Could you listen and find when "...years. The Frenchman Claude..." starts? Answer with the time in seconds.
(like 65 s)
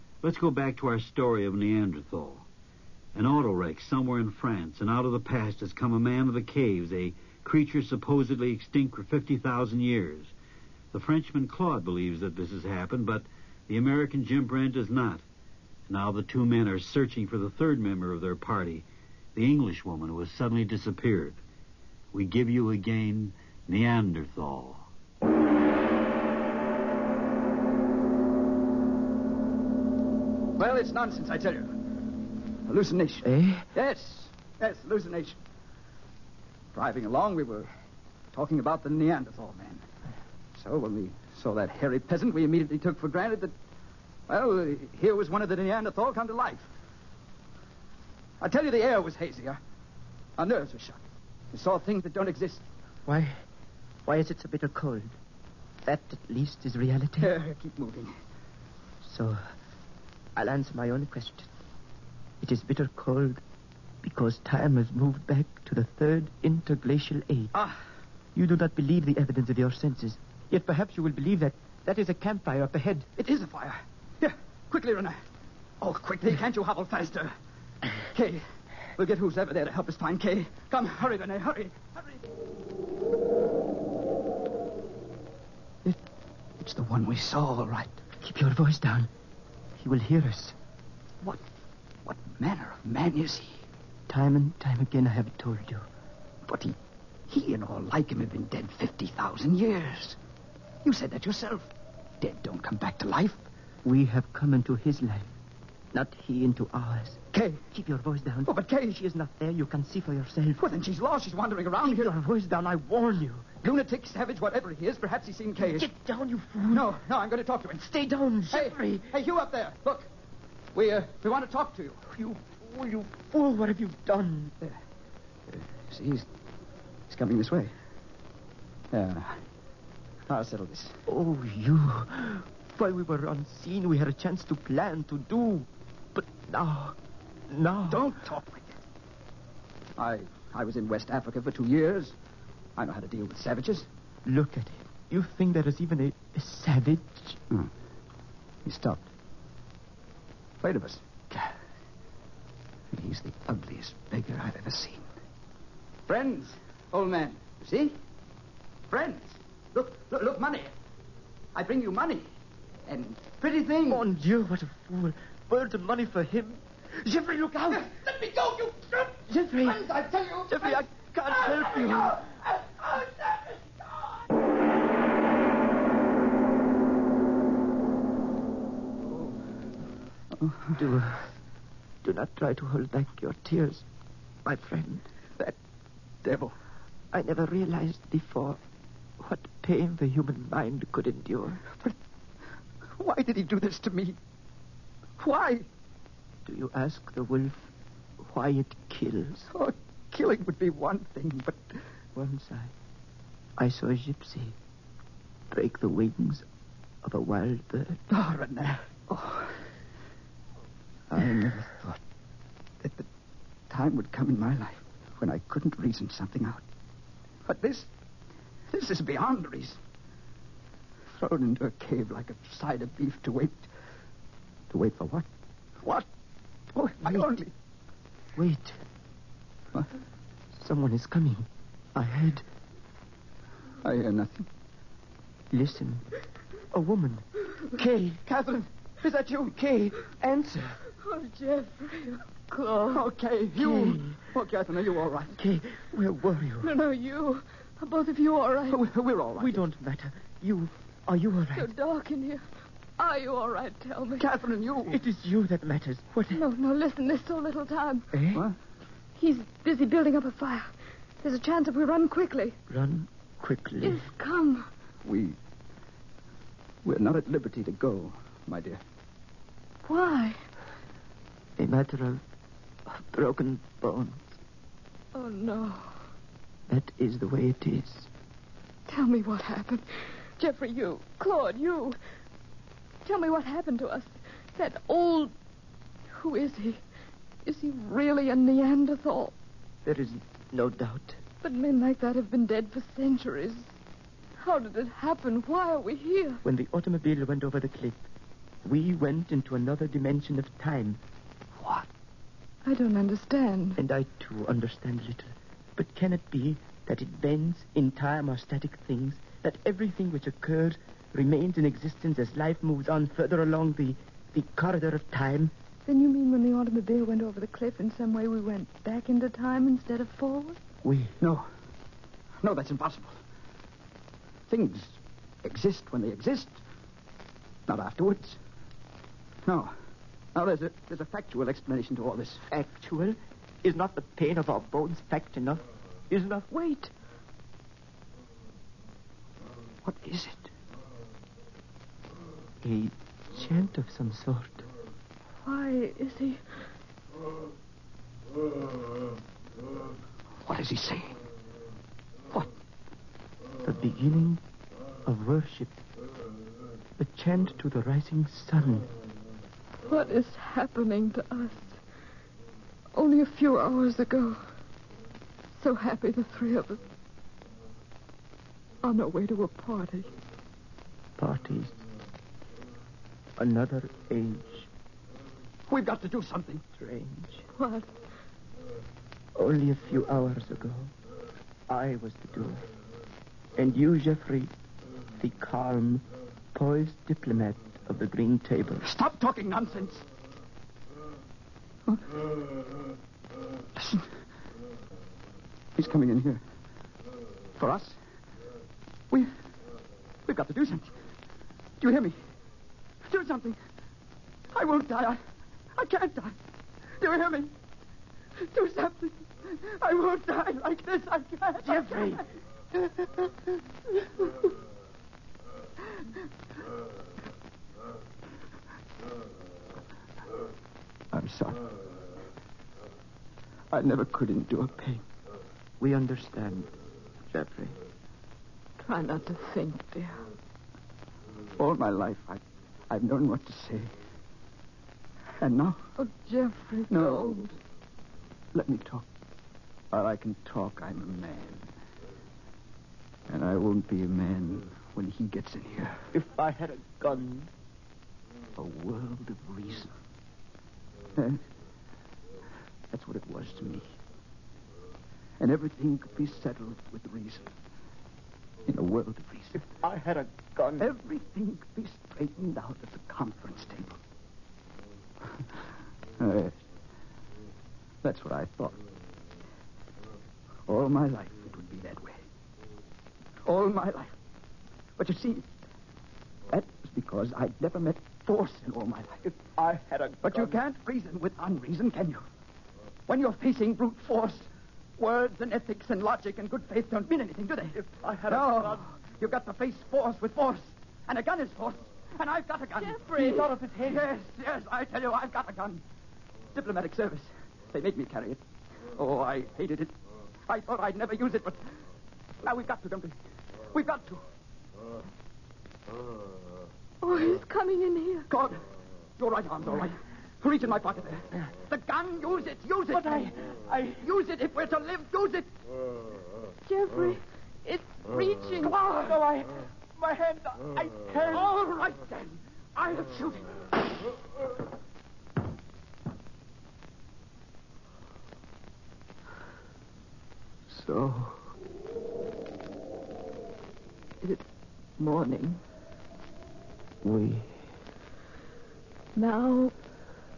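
9 s.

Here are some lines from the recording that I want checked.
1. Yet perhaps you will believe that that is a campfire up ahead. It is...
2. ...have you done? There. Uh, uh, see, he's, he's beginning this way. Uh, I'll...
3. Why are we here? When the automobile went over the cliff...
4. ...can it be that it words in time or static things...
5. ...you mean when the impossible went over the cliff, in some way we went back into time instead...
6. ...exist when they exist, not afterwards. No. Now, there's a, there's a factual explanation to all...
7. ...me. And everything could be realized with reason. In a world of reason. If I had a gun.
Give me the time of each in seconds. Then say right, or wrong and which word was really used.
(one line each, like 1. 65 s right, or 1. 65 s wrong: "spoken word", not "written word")
1. 70 s right
2. 123 s wrong: "coming", not "beginning"
3. 295 s right
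4. 305 s wrong: "bends", not "words"
5. 316 s wrong: "automobile", not "impossible"
6. 325 s right
7. 453 s wrong: "settled", not "realized".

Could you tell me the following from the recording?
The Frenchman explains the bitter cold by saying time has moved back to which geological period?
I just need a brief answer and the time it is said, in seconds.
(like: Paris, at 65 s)
third interglacial age, at 65 s.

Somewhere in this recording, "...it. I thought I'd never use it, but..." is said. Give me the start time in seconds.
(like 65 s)
499 s.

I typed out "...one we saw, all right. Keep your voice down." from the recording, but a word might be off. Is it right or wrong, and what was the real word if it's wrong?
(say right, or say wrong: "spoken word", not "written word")
right.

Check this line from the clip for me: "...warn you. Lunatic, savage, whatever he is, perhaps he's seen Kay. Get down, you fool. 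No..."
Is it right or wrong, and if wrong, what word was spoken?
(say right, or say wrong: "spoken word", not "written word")
right.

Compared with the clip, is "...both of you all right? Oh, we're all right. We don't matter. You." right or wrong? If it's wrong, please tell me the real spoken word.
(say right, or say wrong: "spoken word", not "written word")
right.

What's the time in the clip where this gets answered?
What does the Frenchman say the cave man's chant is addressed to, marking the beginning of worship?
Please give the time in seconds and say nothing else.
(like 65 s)
357 s.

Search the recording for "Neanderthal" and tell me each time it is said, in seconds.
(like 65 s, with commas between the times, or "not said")
1 s, 23 s, 38 s, 45 s, 288 s.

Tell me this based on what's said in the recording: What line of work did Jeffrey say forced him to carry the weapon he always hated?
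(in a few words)
Diplomatic service.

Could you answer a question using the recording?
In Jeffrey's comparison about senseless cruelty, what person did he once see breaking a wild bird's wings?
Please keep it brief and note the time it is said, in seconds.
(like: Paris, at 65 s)
a gypsy, at 203 s.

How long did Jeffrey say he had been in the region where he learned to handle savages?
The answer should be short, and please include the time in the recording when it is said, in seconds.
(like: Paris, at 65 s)
two years, at 141 s.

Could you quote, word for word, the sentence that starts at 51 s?
We saw things that don't exist.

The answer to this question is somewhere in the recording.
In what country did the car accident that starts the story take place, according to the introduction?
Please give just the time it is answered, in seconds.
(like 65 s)
4 s.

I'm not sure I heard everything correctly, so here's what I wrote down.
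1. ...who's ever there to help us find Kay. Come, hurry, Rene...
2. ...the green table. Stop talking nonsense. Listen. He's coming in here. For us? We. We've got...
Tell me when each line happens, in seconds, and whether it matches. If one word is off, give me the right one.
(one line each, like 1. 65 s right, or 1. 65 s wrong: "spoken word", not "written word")
1. 79 s right
2. 387 s right.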